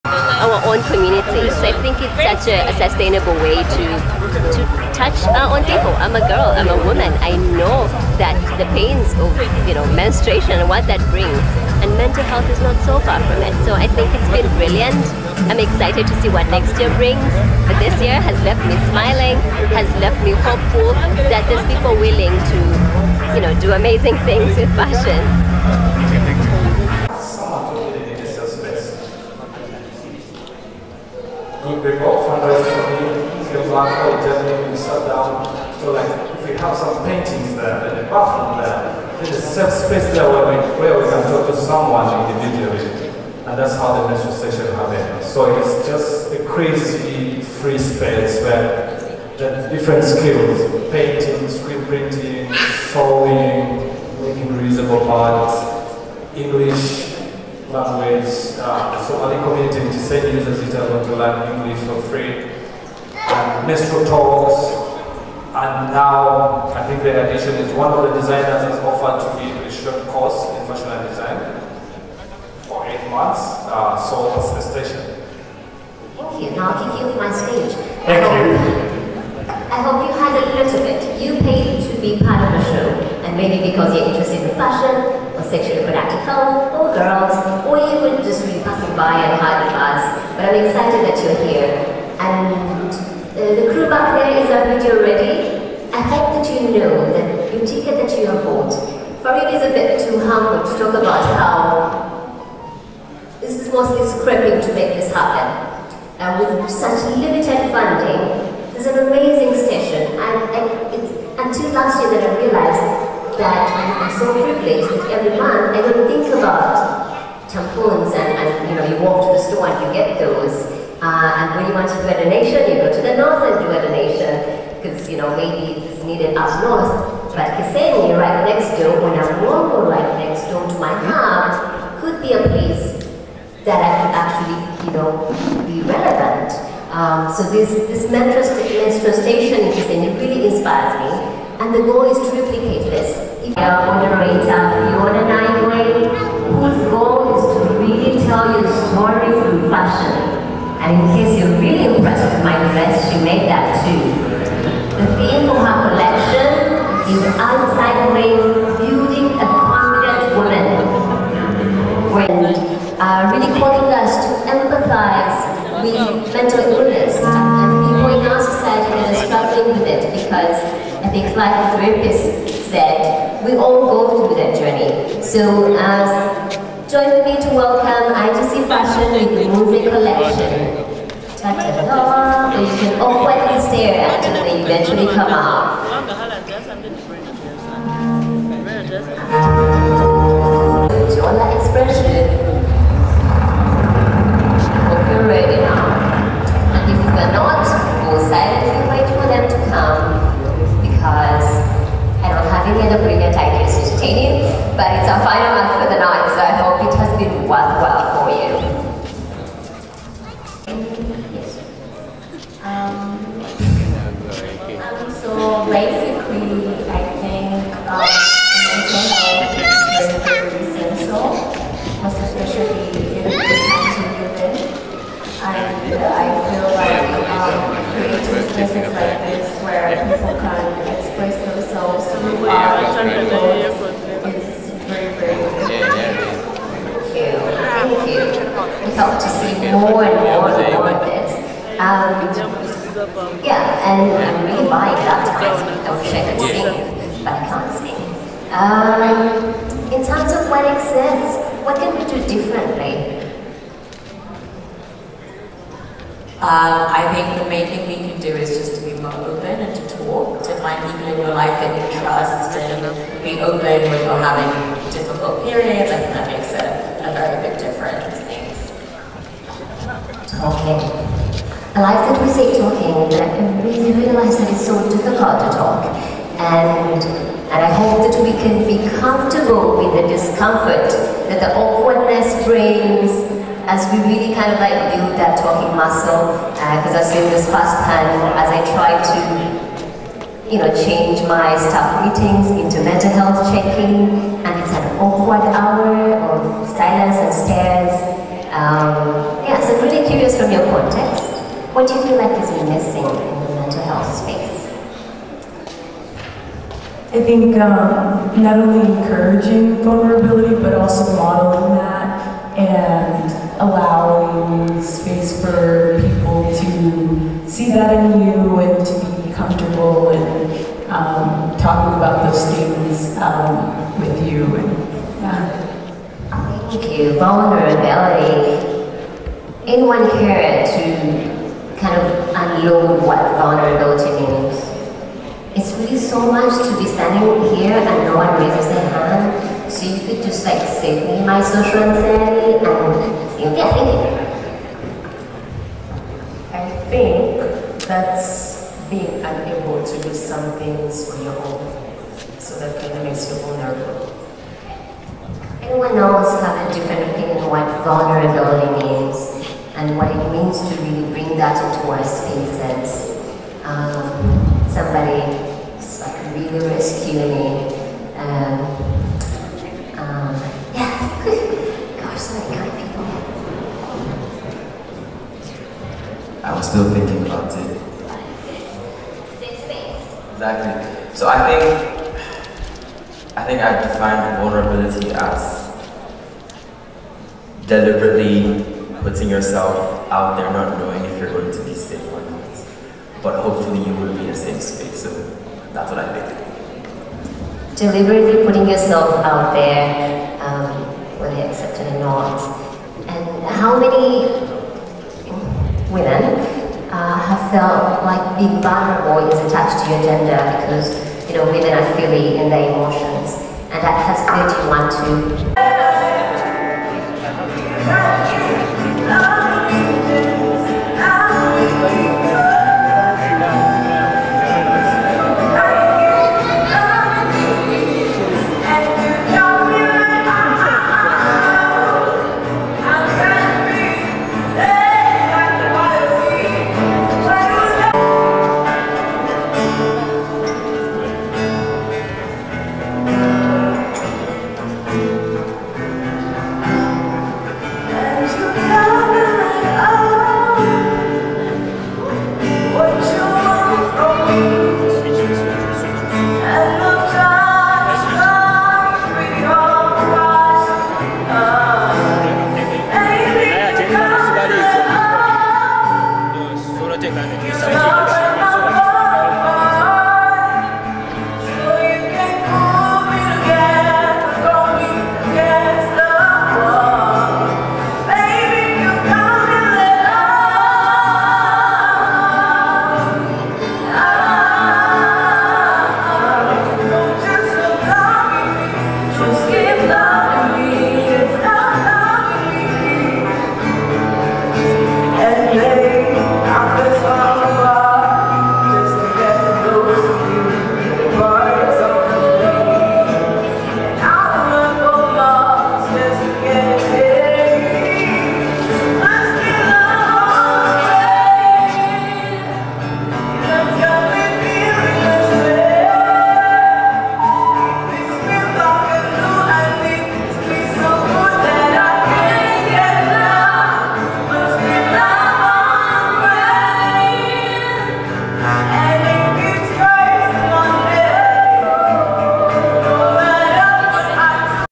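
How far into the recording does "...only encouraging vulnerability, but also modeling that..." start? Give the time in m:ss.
5:08.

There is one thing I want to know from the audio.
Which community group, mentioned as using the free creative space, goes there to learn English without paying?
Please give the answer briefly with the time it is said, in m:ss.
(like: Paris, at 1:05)
Somali, at 0:59.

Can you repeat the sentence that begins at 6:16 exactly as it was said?
I was still thinking about it.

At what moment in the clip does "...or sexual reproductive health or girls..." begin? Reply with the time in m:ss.
1:25.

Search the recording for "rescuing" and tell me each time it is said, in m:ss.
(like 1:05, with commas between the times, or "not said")
6:06.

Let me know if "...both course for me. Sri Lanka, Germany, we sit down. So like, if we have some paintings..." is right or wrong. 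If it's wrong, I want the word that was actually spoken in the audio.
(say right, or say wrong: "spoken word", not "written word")
wrong: "fundraise", not "course".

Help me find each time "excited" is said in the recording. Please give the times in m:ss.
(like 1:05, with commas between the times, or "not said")
0:15, 1:30.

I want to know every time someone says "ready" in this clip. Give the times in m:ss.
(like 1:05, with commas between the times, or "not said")
1:34, 3:15.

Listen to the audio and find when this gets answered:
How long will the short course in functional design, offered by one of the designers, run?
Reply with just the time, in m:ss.
1:12.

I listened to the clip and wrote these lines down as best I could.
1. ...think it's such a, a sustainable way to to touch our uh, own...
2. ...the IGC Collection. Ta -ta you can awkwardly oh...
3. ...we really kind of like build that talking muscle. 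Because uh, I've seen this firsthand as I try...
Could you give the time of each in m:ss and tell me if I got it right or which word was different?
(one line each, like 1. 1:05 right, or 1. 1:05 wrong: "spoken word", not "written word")
1. 0:01 right
2. 2:59 wrong: "Music", not "IGC"
3. 4:43 right.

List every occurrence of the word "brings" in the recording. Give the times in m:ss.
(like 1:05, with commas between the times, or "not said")
0:11, 0:16, 4:42, 6:01.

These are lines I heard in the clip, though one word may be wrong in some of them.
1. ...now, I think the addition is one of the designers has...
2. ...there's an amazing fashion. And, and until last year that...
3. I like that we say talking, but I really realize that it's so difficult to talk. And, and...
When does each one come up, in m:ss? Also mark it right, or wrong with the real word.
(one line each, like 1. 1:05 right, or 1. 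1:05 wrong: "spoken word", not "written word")
1. 1:05 right
2. 1:48 wrong: "station", not "fashion"
3. 4:31 right.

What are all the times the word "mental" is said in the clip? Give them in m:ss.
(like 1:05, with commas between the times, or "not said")
0:11, 4:52, 5:03.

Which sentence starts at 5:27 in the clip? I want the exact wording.
vulnerability, anyone here to kind of unload what vulnerability means?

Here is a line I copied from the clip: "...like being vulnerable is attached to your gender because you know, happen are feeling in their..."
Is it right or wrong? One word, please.
wrong.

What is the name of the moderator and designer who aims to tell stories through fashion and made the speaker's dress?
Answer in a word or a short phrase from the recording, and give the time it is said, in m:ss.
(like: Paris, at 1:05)
Fiona Nightway, at 2:24.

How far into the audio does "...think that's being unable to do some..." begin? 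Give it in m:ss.
5:46.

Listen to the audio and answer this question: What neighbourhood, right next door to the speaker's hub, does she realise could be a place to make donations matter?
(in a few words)
Kisenyi.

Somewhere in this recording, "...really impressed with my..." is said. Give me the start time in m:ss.
2:31.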